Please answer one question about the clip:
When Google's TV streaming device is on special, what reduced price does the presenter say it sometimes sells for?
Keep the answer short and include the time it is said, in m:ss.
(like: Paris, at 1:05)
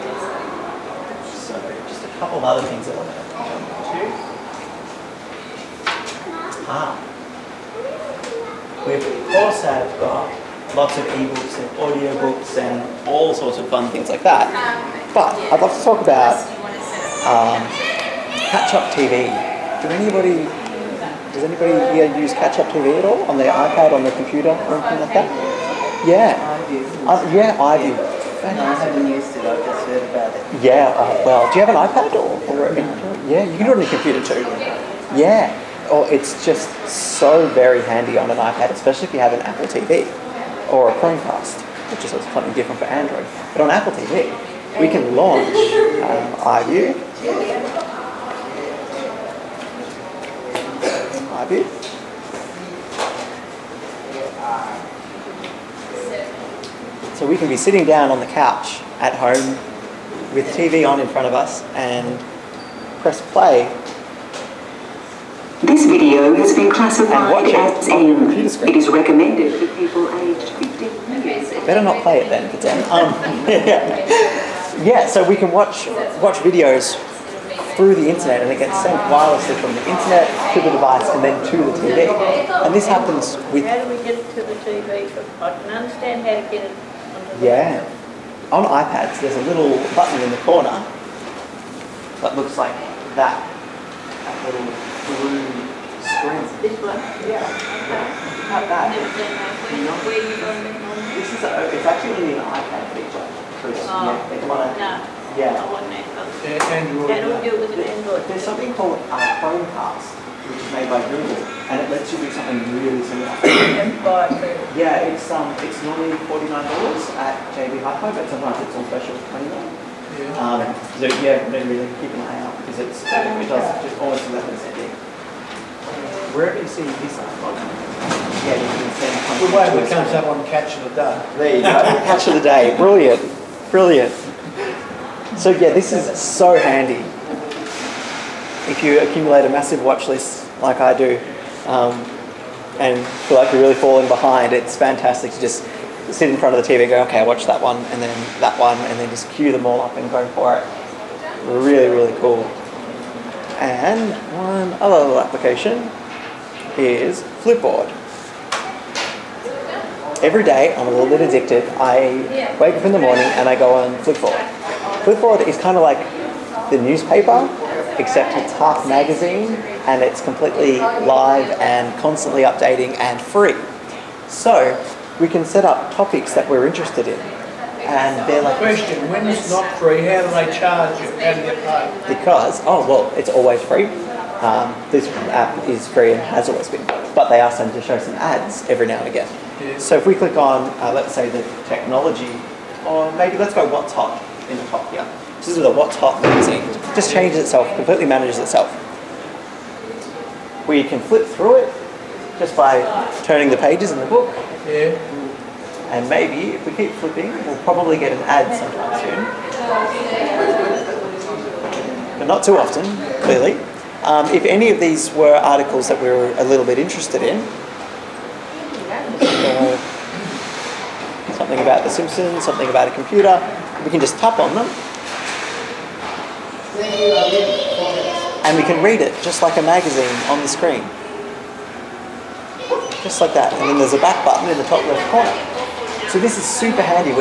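29, at 1:59.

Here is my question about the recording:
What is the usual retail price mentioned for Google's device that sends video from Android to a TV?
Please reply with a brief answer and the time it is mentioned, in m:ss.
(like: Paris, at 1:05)
$49, at 1:56.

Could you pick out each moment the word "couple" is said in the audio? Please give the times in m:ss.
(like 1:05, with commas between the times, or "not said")
0:02.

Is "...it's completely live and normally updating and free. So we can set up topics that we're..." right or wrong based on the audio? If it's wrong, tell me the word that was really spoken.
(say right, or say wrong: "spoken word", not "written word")
wrong: "constantly", not "normally".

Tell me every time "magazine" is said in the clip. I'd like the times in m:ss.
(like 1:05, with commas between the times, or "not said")
2:48, 3:16, 3:49.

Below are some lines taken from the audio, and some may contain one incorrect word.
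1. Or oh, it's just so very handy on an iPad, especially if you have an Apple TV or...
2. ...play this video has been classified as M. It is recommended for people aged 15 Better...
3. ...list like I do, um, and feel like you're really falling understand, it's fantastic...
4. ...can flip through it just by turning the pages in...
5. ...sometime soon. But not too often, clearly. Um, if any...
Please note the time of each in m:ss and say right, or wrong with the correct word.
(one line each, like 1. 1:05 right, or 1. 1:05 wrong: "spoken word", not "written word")
1. 0:35 right
2. 1:03 right
3. 2:20 wrong: "behind", not "understand"
4. 3:20 right
5. 3:28 right.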